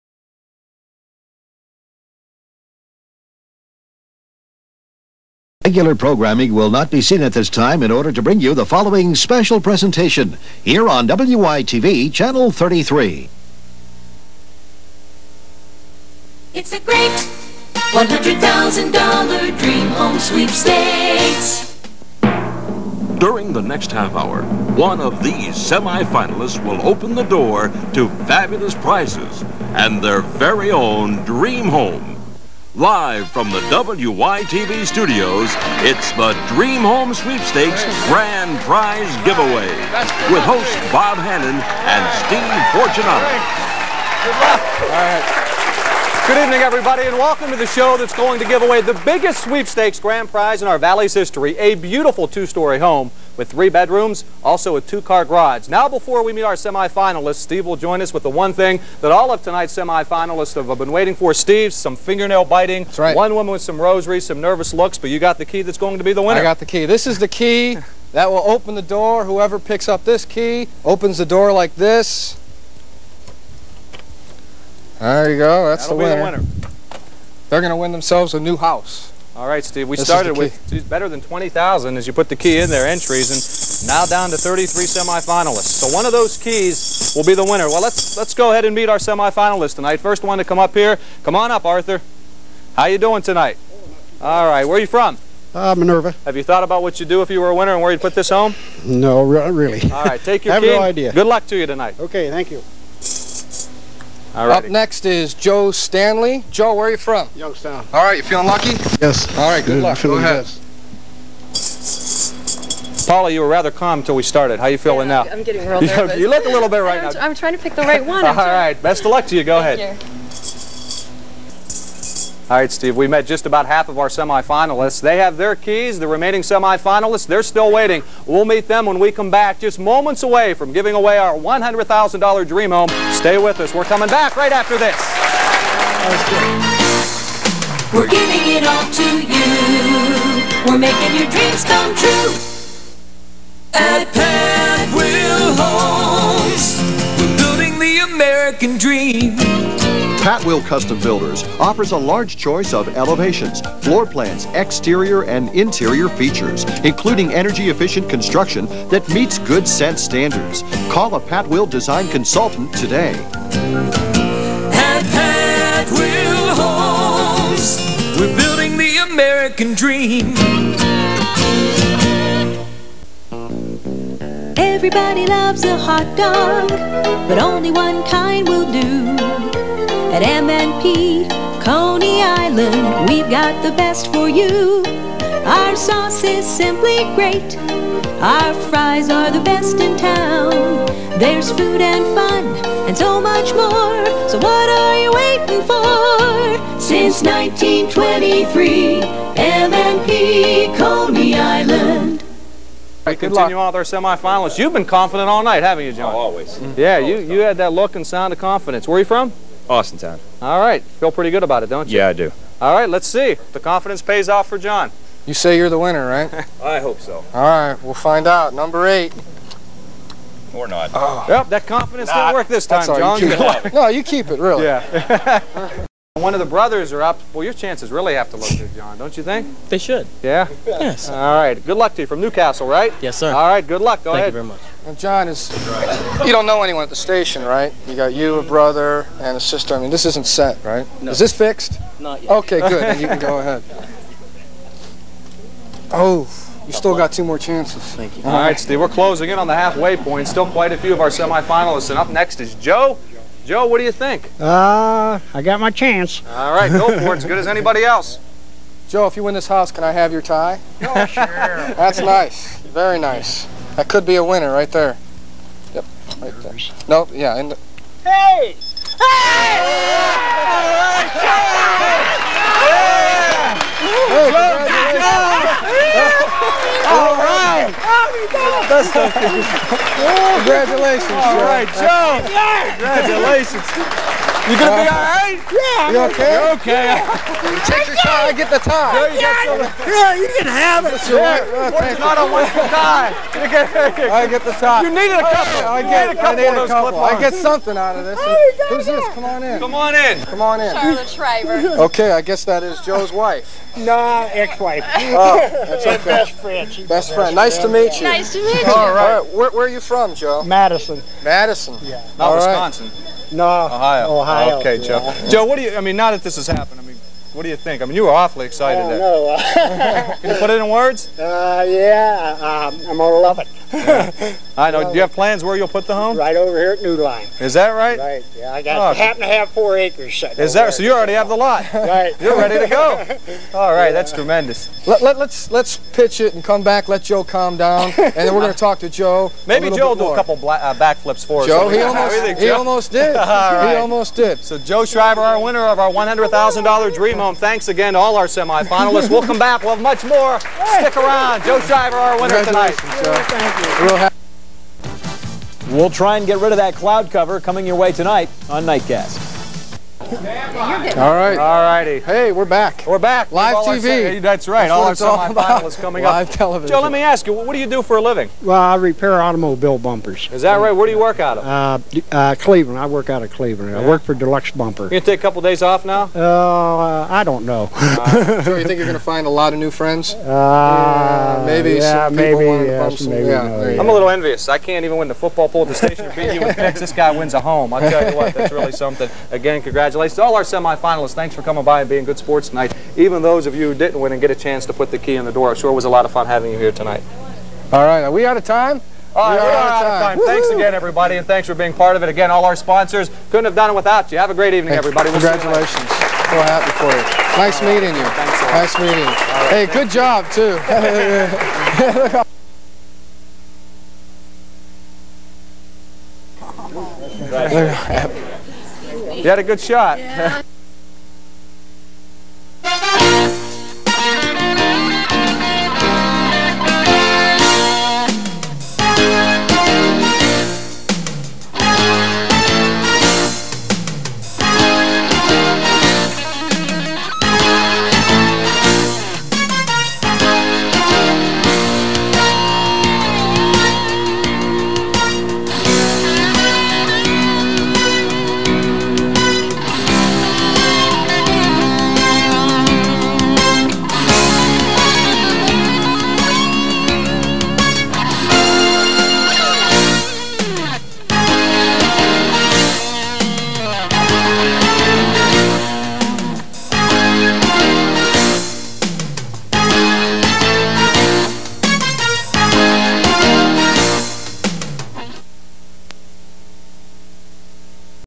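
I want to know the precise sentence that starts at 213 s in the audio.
The confidence pays off for John.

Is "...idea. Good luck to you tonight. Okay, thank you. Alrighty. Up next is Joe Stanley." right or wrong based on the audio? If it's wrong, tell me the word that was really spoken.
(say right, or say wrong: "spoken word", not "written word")
right.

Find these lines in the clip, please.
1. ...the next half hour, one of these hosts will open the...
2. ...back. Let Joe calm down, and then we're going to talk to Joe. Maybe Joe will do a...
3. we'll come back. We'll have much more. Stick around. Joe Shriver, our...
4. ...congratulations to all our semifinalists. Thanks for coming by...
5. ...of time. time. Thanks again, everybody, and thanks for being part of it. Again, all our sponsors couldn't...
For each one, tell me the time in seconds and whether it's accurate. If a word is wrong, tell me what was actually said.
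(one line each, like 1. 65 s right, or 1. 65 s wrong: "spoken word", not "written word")
1. 23 s wrong: "semifinalists", not "hosts"
2. 336 s right
3. 349 s right
4. 390 s right
5. 399 s right.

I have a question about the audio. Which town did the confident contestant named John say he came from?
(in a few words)
Austintown.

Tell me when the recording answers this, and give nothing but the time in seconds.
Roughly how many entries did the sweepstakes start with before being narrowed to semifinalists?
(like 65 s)
81 s.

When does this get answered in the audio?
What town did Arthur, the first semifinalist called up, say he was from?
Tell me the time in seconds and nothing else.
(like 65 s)
95 s.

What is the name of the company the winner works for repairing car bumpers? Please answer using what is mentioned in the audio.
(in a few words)
Deluxe Bumper.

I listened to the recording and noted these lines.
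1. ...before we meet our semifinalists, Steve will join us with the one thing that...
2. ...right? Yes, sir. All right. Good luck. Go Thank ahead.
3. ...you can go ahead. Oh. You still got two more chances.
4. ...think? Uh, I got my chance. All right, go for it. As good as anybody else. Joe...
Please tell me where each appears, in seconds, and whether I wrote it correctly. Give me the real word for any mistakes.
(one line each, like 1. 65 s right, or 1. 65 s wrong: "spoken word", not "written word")
1. 55 s right
2. 232 s right
3. 243 s right
4. 253 s right.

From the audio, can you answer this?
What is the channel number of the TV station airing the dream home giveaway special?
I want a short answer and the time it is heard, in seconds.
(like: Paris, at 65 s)
33, at 12 s.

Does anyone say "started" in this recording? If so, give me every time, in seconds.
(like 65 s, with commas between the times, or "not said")
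80 s, 114 s.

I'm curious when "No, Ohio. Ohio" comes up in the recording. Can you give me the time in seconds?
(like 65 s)
313 s.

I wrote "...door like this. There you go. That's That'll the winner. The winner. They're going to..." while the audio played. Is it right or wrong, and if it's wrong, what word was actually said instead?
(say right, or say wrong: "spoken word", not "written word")
right.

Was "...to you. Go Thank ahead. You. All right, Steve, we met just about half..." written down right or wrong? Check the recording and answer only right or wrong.
right.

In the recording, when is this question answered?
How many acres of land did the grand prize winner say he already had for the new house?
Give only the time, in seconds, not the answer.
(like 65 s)
329 s.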